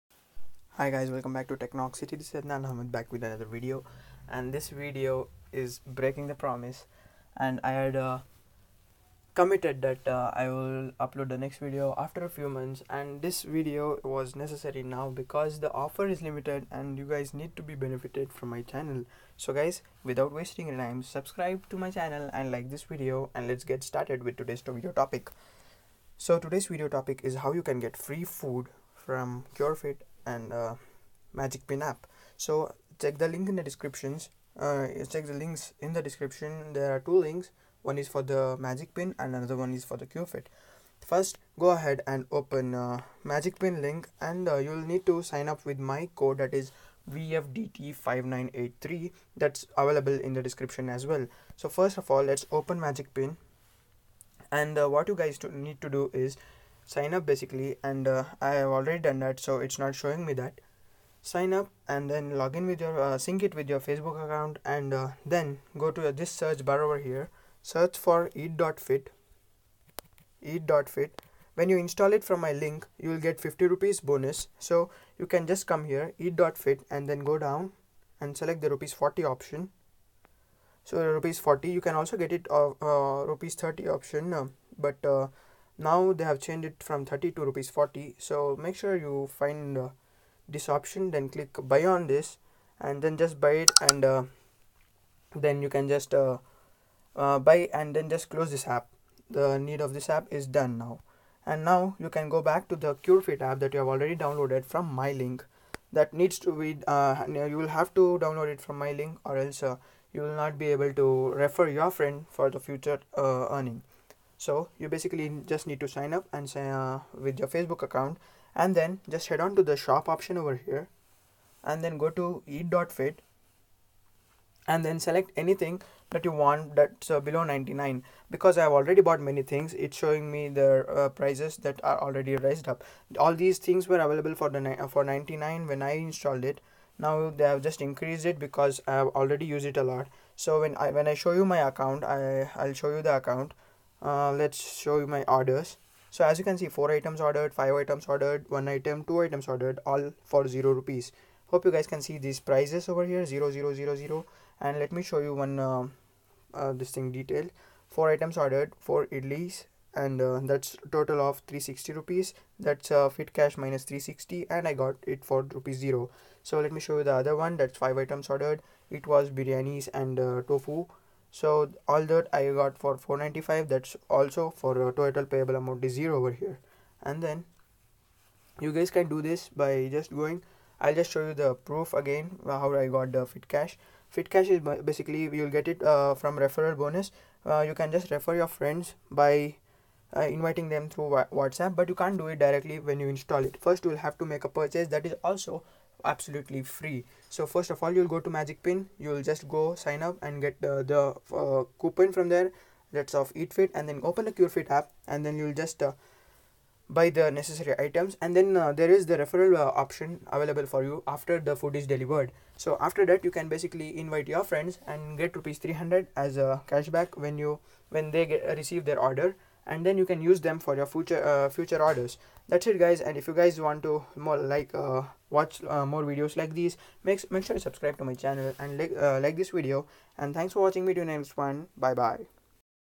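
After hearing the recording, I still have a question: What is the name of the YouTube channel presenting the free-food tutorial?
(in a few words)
Technoxity.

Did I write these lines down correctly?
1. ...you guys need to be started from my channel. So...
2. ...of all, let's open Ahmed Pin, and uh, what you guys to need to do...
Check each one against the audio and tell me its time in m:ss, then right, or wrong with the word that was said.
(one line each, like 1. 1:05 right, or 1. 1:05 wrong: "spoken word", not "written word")
1. 0:16 wrong: "benefited", not "started"
2. 0:51 wrong: "Magic", not "Ahmed".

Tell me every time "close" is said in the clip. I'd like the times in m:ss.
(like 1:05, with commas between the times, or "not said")
1:38.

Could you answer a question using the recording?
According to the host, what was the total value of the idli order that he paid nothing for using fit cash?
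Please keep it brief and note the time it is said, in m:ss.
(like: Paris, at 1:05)
360 rupees, at 2:41.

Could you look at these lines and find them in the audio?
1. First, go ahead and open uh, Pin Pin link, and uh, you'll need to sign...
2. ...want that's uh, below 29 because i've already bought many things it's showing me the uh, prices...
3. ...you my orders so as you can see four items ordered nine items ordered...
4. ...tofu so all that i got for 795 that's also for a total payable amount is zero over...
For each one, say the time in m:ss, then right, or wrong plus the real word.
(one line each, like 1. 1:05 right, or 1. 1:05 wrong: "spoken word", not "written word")
1. 0:41 wrong: "Magic", not "Pin"
2. 2:06 wrong: "99", not "29"
3. 2:24 wrong: "five", not "nine"
4. 2:50 wrong: "495", not "795".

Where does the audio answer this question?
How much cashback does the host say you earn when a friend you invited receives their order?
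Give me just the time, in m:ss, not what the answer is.
3:35.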